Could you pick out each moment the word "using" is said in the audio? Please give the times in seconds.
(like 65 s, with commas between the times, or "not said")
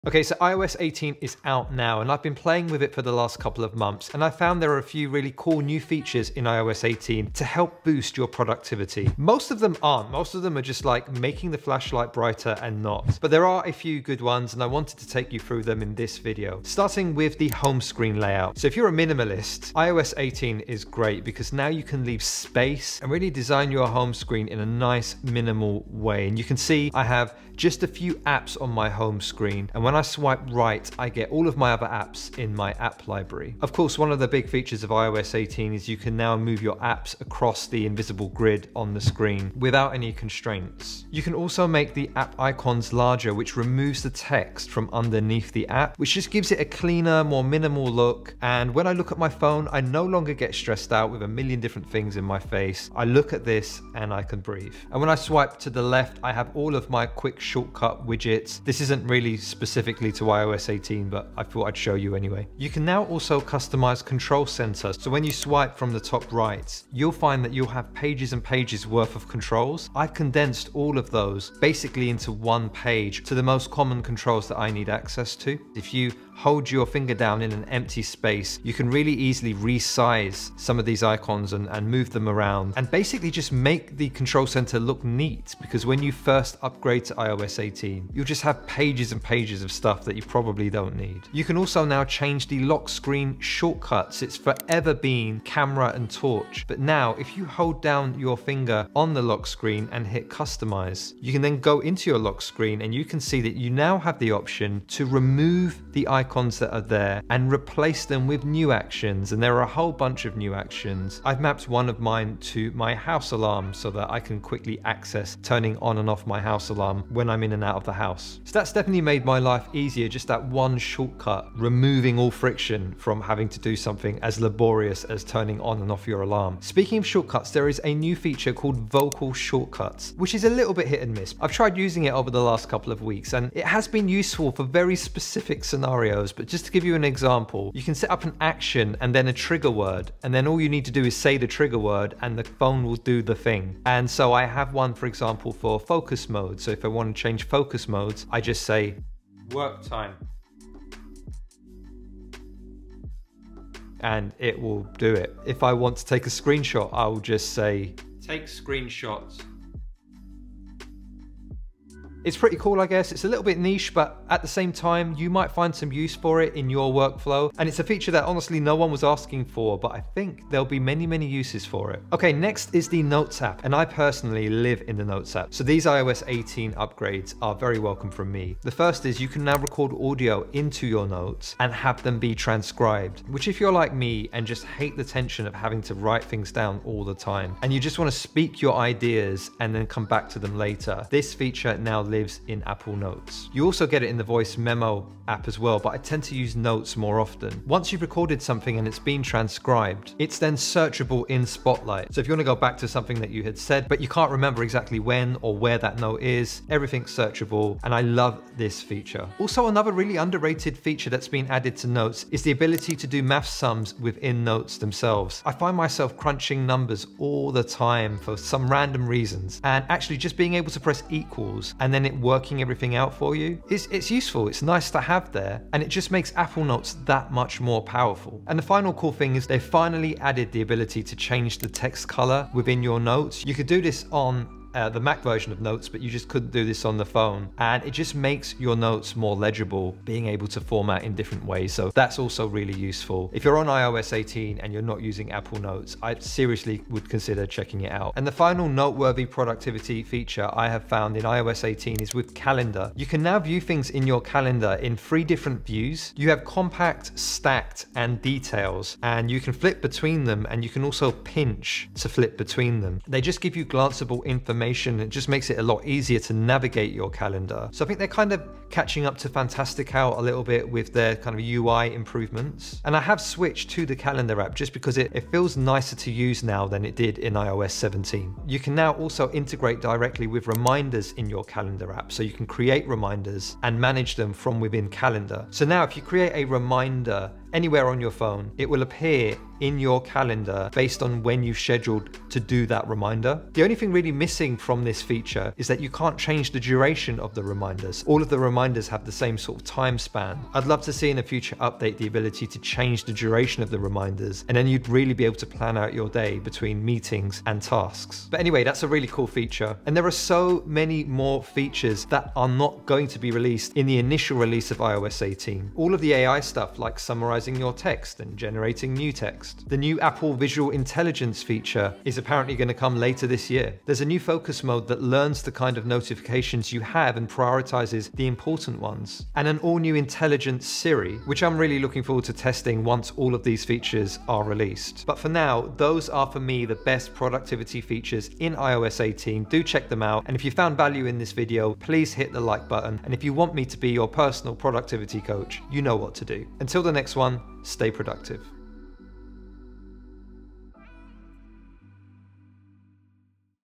131 s, 245 s.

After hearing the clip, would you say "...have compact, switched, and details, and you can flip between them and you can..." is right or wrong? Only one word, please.
wrong.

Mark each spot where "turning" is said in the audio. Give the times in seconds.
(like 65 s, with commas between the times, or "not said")
115 s, 125 s.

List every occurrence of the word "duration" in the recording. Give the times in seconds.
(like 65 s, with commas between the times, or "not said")
296 s, 303 s.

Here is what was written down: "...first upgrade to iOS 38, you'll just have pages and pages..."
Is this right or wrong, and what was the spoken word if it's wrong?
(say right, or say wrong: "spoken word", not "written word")
wrong: "18", not "38".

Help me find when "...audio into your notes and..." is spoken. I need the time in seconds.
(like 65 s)
179 s.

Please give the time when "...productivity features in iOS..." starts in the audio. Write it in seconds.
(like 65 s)
337 s.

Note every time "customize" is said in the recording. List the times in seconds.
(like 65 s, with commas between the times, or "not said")
63 s, 100 s.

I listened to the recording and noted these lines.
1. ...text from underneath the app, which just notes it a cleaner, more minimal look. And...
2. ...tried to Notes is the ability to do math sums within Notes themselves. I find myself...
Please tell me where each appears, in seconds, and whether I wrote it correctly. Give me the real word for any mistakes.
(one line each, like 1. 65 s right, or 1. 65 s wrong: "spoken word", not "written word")
1. 44 s wrong: "gives", not "notes"
2. 211 s wrong: "added", not "tried".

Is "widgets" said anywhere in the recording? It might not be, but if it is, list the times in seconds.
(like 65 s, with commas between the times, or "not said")
58 s.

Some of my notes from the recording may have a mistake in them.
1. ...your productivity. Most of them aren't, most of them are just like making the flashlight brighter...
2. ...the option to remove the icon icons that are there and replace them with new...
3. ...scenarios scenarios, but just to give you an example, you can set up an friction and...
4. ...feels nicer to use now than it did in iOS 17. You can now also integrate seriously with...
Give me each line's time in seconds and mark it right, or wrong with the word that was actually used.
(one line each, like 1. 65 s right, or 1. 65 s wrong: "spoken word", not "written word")
1. 8 s right
2. 104 s right
3. 135 s wrong: "action", not "friction"
4. 275 s wrong: "directly", not "seriously".